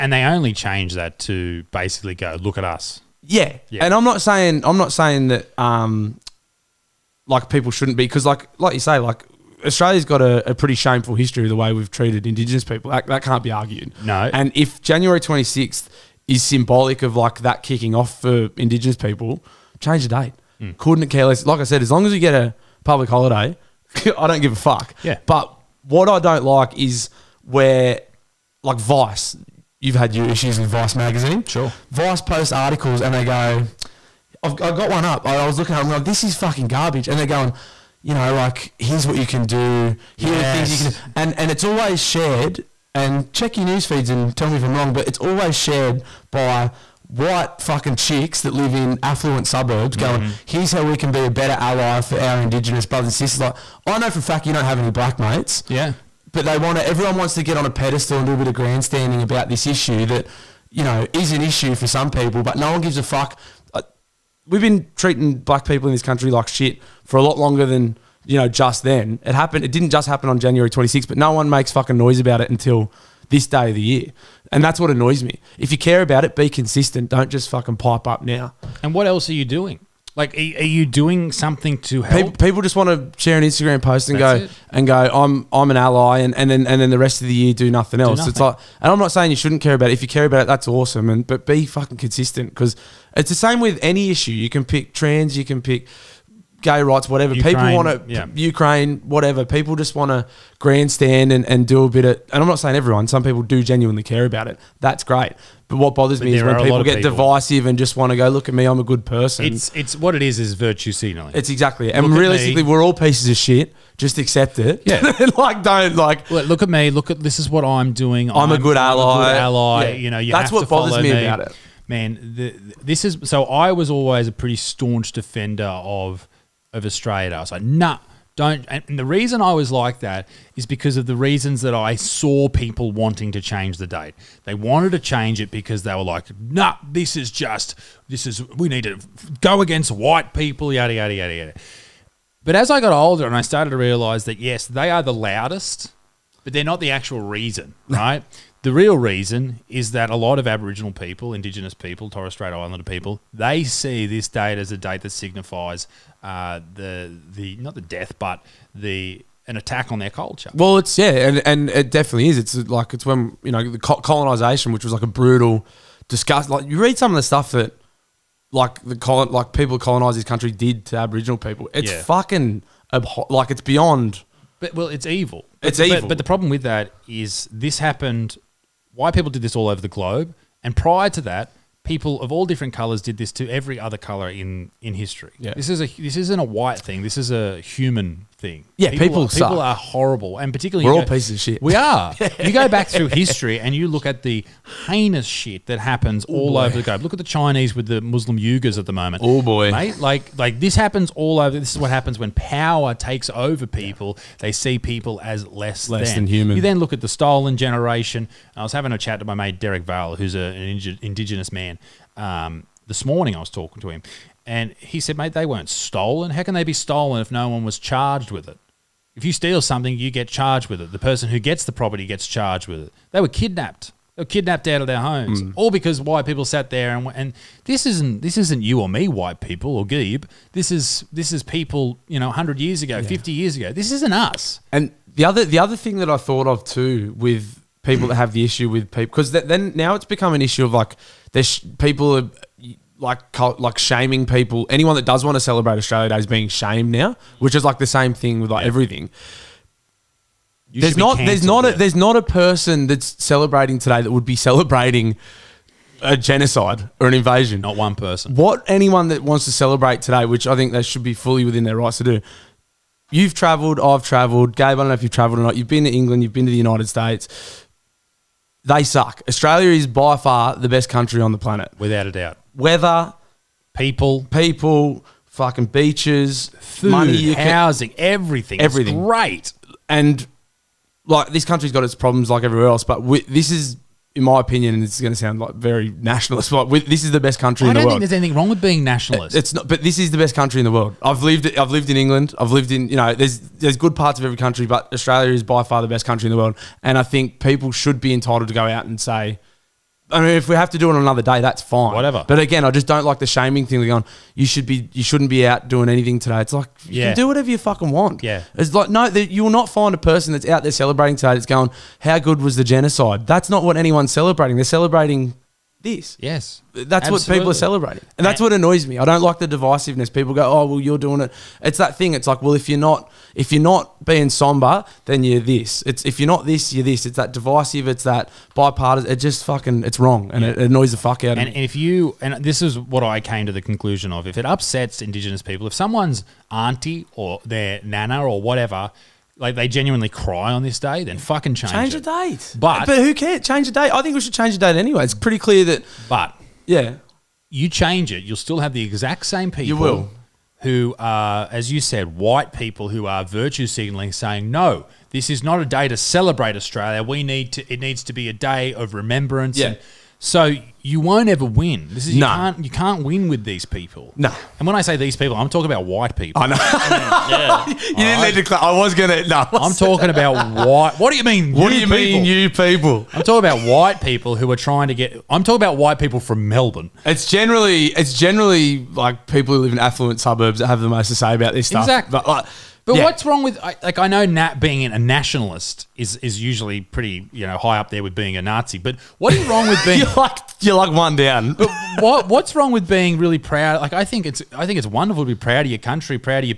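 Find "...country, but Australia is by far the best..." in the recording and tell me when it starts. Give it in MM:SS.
04:54.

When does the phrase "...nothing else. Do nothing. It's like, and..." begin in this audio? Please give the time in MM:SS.
01:27.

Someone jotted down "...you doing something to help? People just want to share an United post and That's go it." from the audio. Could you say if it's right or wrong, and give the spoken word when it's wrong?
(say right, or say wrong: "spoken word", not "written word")
wrong: "Instagram", not "United".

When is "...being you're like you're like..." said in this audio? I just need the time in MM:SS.
06:29.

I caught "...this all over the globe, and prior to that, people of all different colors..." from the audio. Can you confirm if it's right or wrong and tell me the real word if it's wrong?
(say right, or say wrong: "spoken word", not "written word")
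right.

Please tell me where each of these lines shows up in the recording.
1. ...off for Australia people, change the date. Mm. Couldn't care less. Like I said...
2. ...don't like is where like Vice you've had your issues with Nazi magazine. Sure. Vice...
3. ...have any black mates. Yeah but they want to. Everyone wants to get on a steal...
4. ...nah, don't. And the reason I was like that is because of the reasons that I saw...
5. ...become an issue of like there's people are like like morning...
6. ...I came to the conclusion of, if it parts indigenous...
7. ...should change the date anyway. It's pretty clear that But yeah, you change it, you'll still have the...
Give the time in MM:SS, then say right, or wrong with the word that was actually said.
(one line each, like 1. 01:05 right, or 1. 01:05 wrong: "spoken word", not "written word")
1. 00:17 wrong: "Indigenous", not "Australia"
2. 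00:26 wrong: "Vice", not "Nazi"
3. 00:54 wrong: "pedestal", not "steal"
4. 02:07 right
5. 04:00 wrong: "shaming", not "morning"
6. 05:33 wrong: "upsets", not "parts"
7. 05:44 right.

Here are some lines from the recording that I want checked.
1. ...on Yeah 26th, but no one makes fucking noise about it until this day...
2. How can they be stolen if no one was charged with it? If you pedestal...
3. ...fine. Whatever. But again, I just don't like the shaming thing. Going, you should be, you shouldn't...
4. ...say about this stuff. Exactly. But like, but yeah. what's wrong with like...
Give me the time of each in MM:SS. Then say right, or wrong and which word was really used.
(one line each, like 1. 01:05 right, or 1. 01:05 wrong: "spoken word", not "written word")
1. 01:10 wrong: "January", not "Yeah"
2. 03:36 wrong: "steal", not "pedestal"
3. 05:01 right
4. 06:21 right.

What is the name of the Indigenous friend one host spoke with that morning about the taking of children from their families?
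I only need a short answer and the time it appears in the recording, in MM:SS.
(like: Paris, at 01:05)
Derek Vale, at 03:29.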